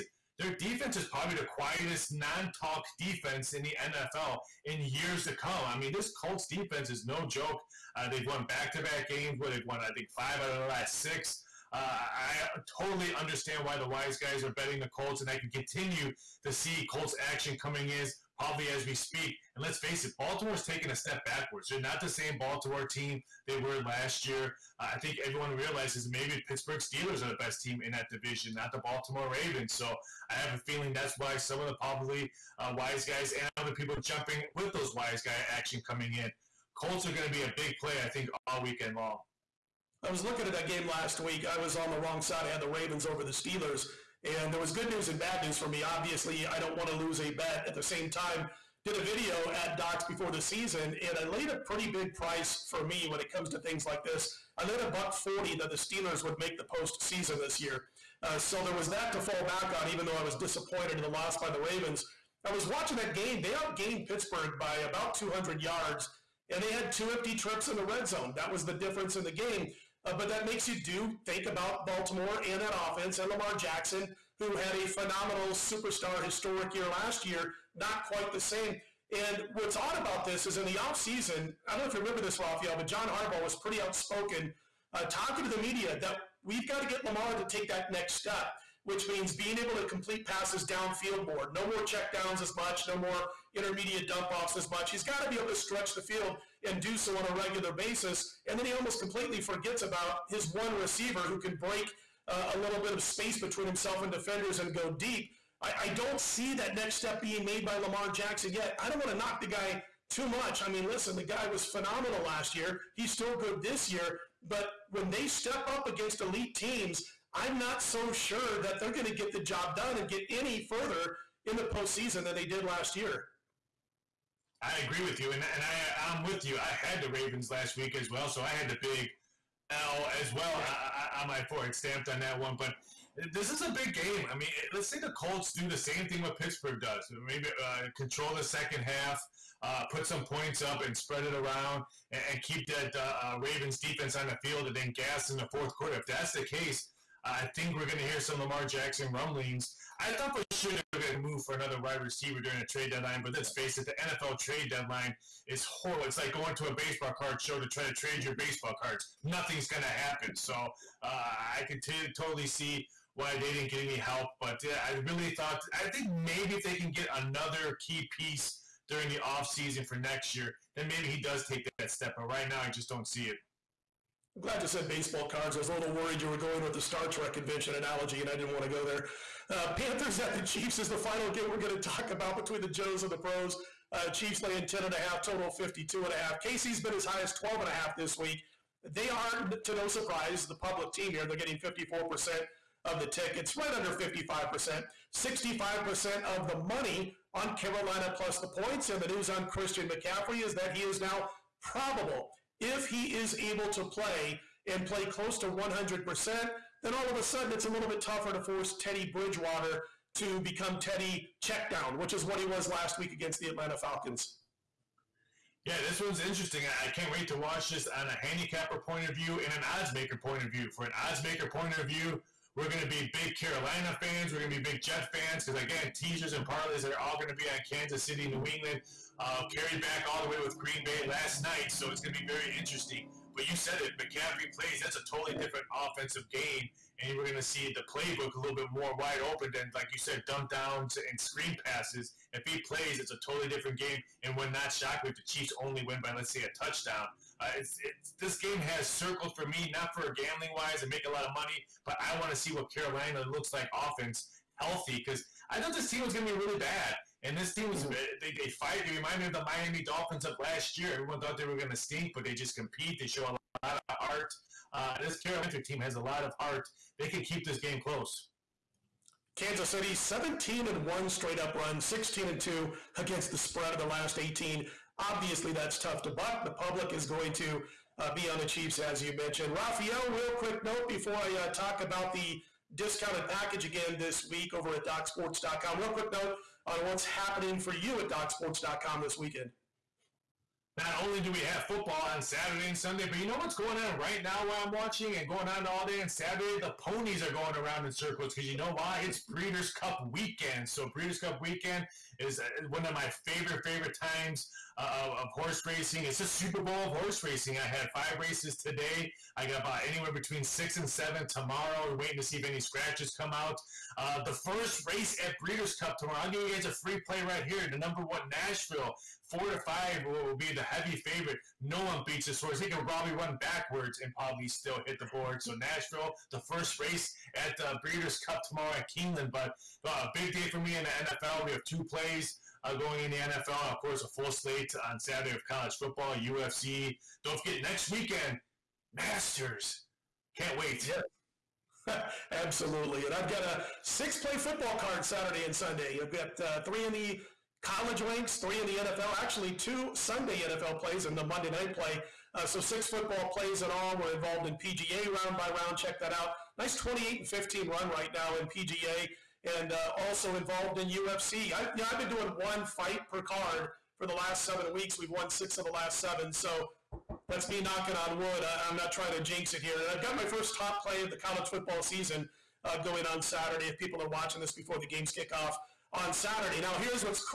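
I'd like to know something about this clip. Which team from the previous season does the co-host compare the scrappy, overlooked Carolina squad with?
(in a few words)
Miami Dolphins.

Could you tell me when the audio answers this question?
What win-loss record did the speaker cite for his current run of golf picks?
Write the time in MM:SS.
05:56.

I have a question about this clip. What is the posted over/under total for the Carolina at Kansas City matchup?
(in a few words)
52.5.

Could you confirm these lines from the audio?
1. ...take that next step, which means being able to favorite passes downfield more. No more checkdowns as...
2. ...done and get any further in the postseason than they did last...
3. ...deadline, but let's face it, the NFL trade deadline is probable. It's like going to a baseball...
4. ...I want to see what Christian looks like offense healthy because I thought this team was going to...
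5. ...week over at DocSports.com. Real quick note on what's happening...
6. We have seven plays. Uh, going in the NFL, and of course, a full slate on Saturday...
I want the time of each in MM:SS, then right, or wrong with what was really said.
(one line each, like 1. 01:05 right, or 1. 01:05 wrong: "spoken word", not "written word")
1. 01:27 wrong: "complete", not "favorite"
2. 01:59 right
3. 02:32 wrong: "horrible", not "probable"
4. 04:12 wrong: "Carolina", not "Christian"
5. 04:44 right
6. 05:31 wrong: "two", not "seven".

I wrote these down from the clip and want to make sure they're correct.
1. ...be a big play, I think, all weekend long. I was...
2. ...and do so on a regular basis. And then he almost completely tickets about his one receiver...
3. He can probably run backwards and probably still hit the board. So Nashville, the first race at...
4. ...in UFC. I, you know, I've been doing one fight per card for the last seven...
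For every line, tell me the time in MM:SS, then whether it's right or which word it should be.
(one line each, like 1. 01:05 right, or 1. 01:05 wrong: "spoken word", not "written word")
1. 00:37 right
2. 01:36 wrong: "forgets", not "tickets"
3. 05:22 right
4. 06:00 right.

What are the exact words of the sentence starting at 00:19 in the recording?
And let's face it, Baltimore's taken a step backwards.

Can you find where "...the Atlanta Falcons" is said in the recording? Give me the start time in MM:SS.
03:33.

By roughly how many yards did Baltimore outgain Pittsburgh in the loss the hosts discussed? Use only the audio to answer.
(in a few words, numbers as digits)
200.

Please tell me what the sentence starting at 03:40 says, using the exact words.
For an odds maker point of view, we're going to be big Carolina fans.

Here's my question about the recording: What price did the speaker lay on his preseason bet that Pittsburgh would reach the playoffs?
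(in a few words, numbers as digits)
140.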